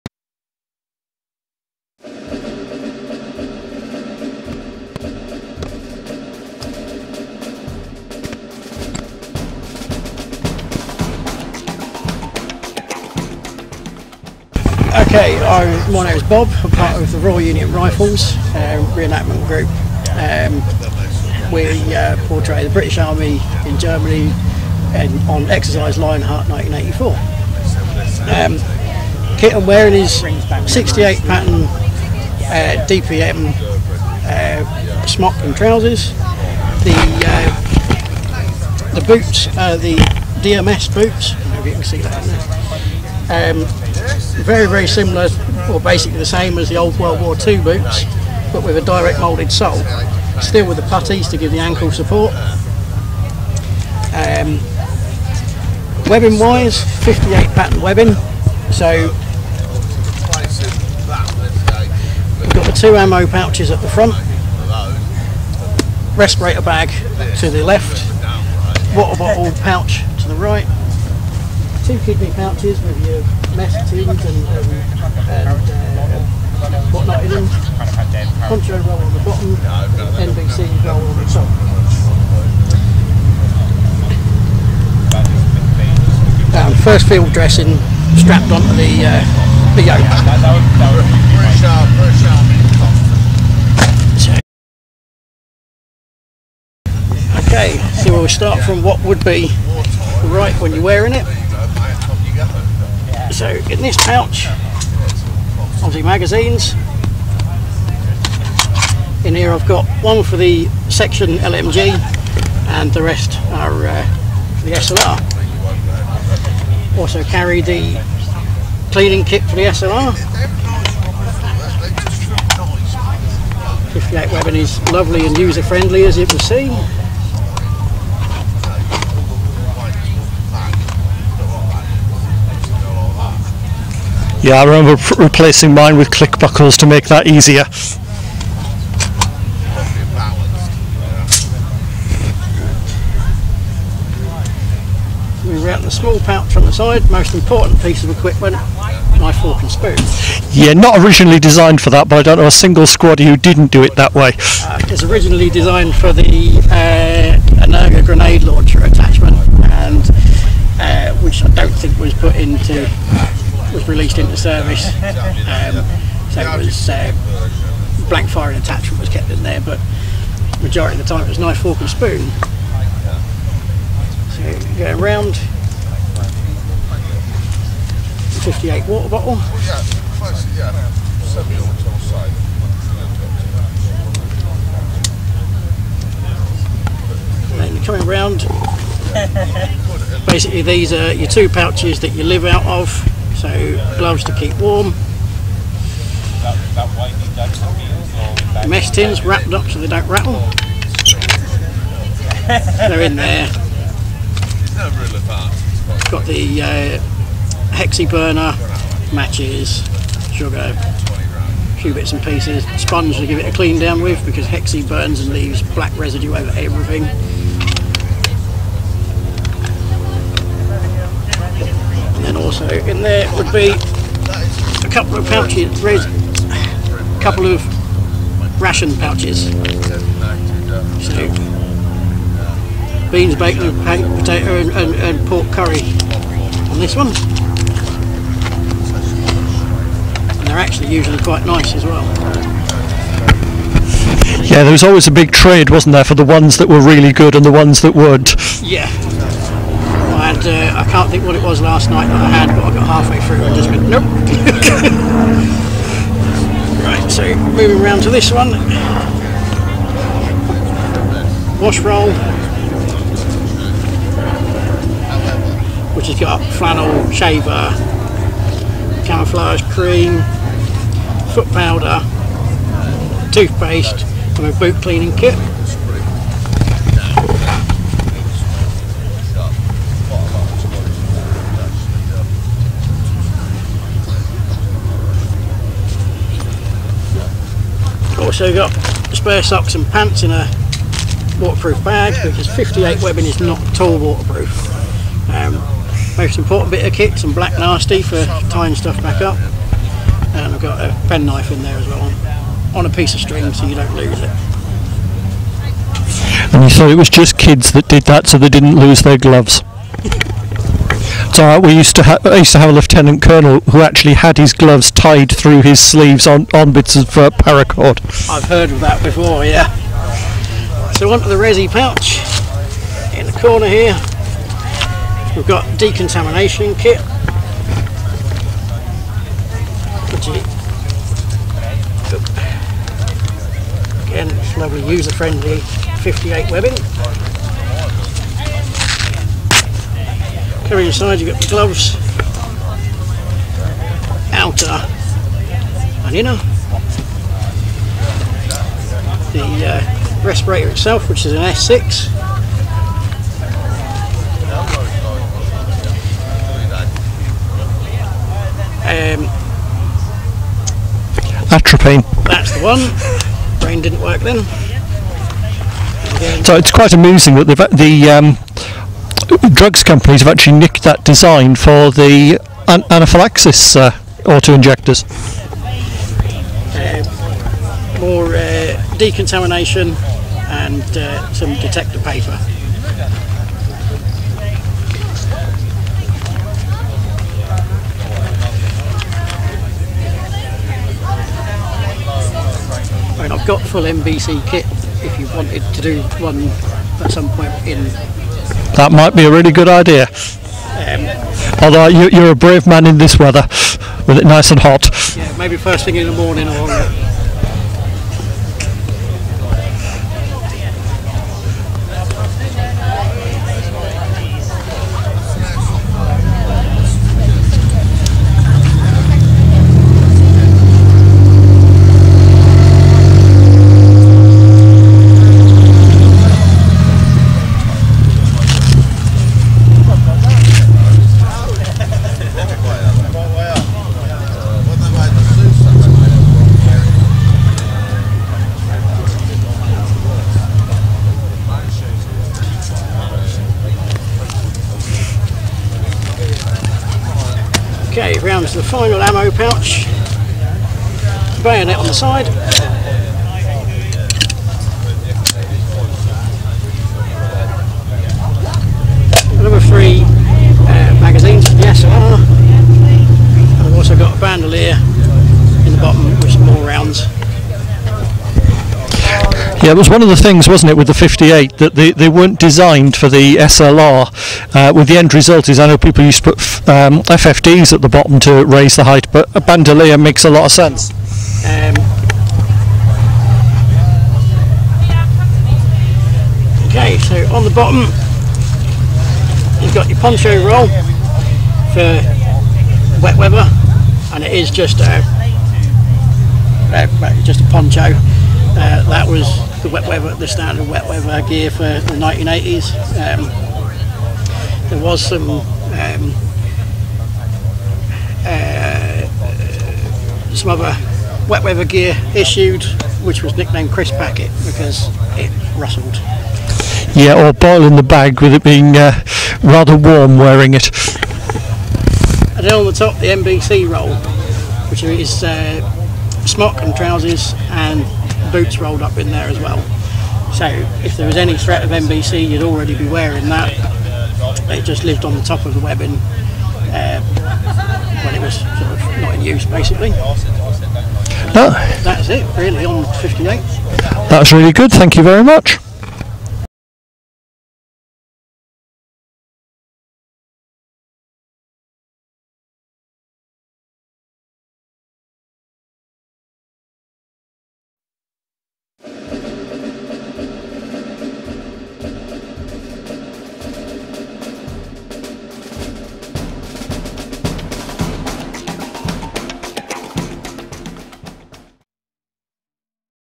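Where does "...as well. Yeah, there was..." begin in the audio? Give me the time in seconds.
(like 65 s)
241 s.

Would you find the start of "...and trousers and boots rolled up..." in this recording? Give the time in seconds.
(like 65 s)
526 s.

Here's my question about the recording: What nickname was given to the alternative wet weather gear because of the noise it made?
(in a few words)
Crisp Packet.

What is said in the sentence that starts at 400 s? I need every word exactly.
Um, Although you, are a brave man in this weather, with it nice and hot.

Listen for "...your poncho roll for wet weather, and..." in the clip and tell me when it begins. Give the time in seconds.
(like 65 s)
489 s.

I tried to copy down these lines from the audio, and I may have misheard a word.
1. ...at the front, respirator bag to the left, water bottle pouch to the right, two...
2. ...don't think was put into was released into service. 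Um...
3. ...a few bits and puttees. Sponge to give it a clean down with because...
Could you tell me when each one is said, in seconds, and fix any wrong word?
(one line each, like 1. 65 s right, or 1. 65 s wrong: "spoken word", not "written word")
1. 63 s right
2. 161 s right
3. 210 s wrong: "pieces", not "puttees".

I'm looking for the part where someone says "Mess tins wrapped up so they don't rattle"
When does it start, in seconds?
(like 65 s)
198 s.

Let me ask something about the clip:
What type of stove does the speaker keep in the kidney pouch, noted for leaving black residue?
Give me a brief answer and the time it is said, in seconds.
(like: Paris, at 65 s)
hexi burner, at 207 s.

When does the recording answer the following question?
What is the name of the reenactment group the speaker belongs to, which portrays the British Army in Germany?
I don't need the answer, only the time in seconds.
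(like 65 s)
17 s.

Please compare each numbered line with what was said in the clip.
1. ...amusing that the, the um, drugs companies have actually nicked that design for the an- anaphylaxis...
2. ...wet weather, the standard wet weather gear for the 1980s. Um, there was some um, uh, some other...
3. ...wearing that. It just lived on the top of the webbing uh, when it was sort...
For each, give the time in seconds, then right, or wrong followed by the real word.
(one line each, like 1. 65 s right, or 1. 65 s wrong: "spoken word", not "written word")
1. 366 s right
2. 499 s right
3. 532 s right.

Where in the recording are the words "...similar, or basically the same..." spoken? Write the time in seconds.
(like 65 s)
44 s.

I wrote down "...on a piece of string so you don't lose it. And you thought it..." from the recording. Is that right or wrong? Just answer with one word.
right.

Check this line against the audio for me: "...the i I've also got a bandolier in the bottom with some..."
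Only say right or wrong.
right.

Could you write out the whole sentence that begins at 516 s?
Yeah, or boiling the bag with it being uh, rather warm wearing it.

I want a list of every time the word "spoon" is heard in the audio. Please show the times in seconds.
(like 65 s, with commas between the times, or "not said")
149 s, 171 s.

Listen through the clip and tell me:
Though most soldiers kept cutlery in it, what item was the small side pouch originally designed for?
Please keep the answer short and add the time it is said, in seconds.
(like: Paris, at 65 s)
grenade launcher attachment, at 158 s.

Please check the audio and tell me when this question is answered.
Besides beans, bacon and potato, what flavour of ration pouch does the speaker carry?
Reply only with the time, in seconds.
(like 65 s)
235 s.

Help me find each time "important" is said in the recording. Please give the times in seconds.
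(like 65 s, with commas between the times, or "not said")
147 s, 296 s.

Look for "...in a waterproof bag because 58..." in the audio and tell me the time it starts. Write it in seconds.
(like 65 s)
290 s.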